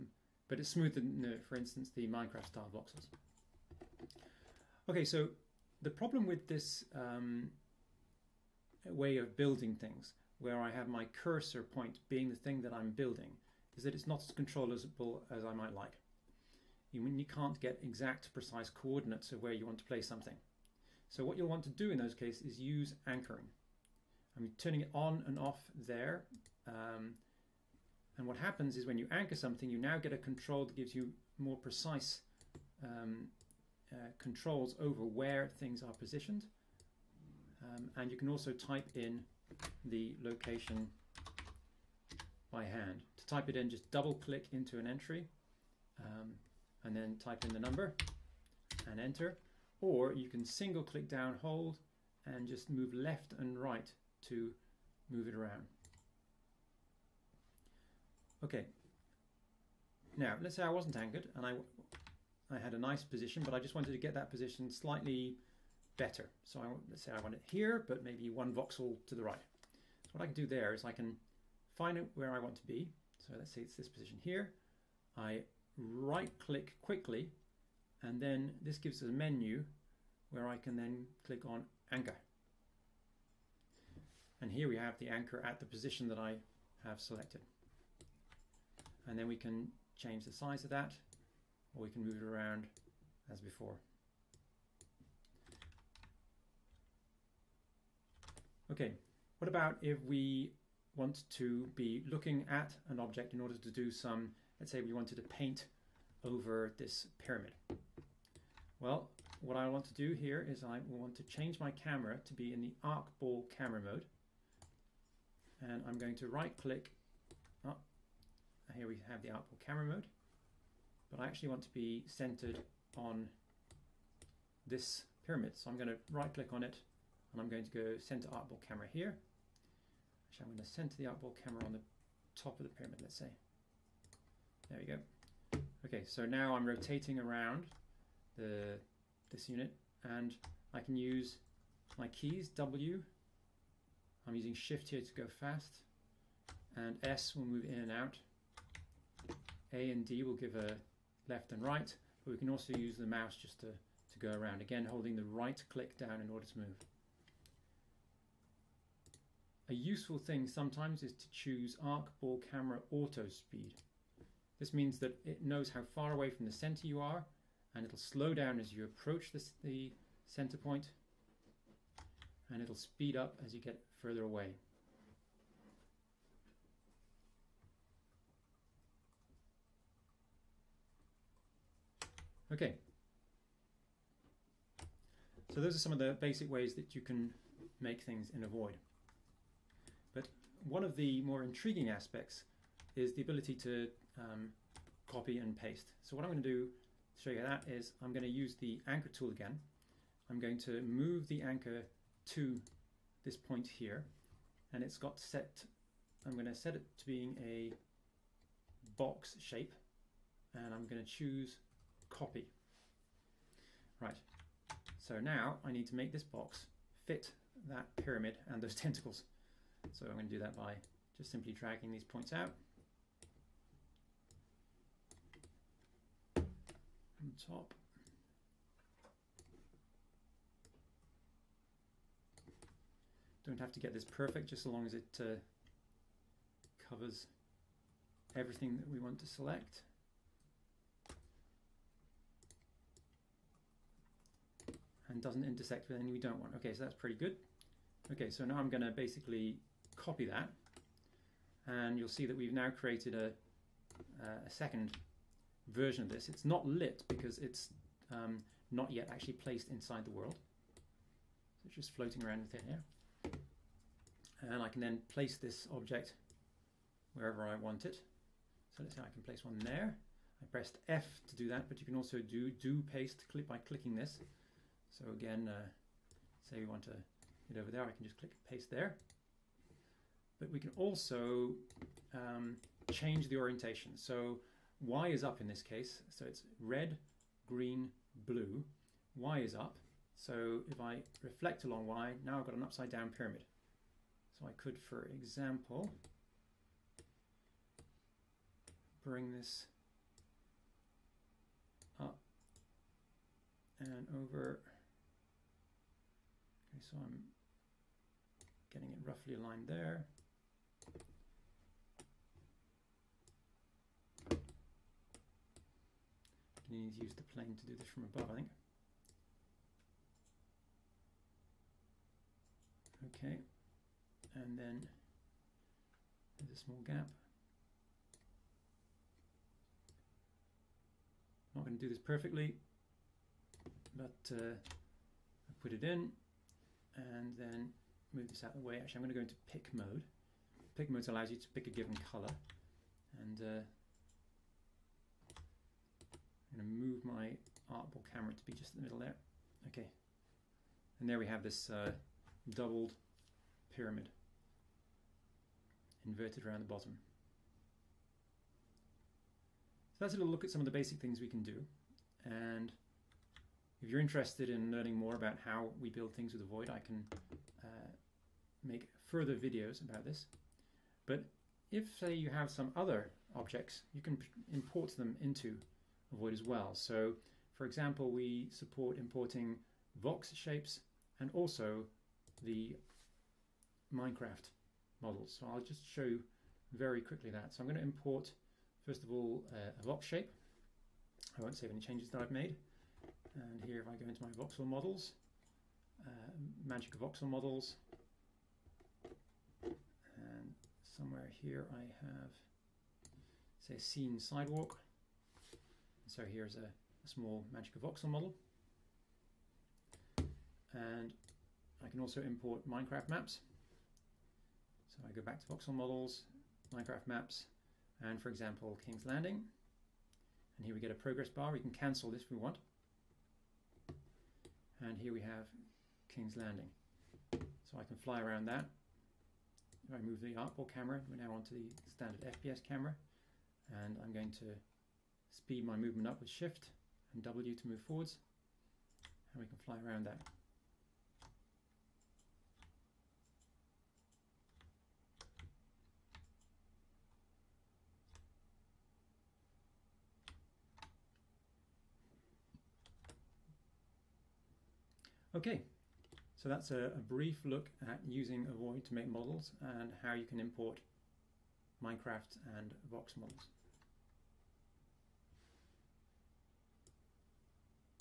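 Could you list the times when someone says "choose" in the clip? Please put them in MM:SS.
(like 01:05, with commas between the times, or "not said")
02:41, 03:31.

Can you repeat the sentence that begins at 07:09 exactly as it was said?
If I move the arcball camera, we're now onto the standard FPS camera.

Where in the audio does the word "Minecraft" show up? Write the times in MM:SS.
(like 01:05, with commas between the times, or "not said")
00:02, 06:23, 06:52, 06:56, 07:41.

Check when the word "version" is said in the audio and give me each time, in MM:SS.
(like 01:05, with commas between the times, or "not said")
04:15.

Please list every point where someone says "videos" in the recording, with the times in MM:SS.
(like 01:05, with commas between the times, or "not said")
06:09.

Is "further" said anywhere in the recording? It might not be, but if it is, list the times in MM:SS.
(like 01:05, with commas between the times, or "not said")
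02:54, 06:09.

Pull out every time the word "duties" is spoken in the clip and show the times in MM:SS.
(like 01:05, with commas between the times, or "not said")
not said.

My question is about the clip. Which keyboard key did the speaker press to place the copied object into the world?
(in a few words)
F.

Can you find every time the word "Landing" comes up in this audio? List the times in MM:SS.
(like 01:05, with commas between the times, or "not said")
06:59, 07:06.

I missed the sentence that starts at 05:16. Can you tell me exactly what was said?
you need to use the plane to do this from above, I think.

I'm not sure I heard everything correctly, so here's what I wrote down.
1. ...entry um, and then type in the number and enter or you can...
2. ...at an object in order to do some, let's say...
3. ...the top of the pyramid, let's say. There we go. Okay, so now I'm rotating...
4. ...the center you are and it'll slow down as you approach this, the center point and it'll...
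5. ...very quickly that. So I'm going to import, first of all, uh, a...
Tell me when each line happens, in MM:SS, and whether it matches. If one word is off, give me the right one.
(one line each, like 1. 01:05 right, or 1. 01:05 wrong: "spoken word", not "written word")
1. 00:44 right
2. 01:42 right
3. 02:11 right
4. 02:46 right
5. 06:26 right.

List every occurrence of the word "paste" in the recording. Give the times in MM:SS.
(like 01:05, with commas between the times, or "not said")
03:15, 04:32, 04:38.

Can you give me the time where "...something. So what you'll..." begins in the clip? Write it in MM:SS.
00:20.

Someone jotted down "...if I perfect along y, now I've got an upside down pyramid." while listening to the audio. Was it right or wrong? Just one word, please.
wrong.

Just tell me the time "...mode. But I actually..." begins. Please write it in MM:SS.
01:59.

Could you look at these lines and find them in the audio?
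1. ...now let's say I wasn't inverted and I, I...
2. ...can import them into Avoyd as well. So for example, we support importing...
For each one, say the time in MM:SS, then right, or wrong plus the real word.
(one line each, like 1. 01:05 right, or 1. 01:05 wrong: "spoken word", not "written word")
1. 01:00 wrong: "anchored", not "inverted"
2. 06:14 right.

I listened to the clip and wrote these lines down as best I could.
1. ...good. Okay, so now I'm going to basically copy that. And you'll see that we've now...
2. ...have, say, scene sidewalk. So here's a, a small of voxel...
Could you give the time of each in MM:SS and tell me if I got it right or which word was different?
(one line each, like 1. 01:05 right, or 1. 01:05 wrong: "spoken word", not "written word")
1. 04:07 right
2. 06:42 right.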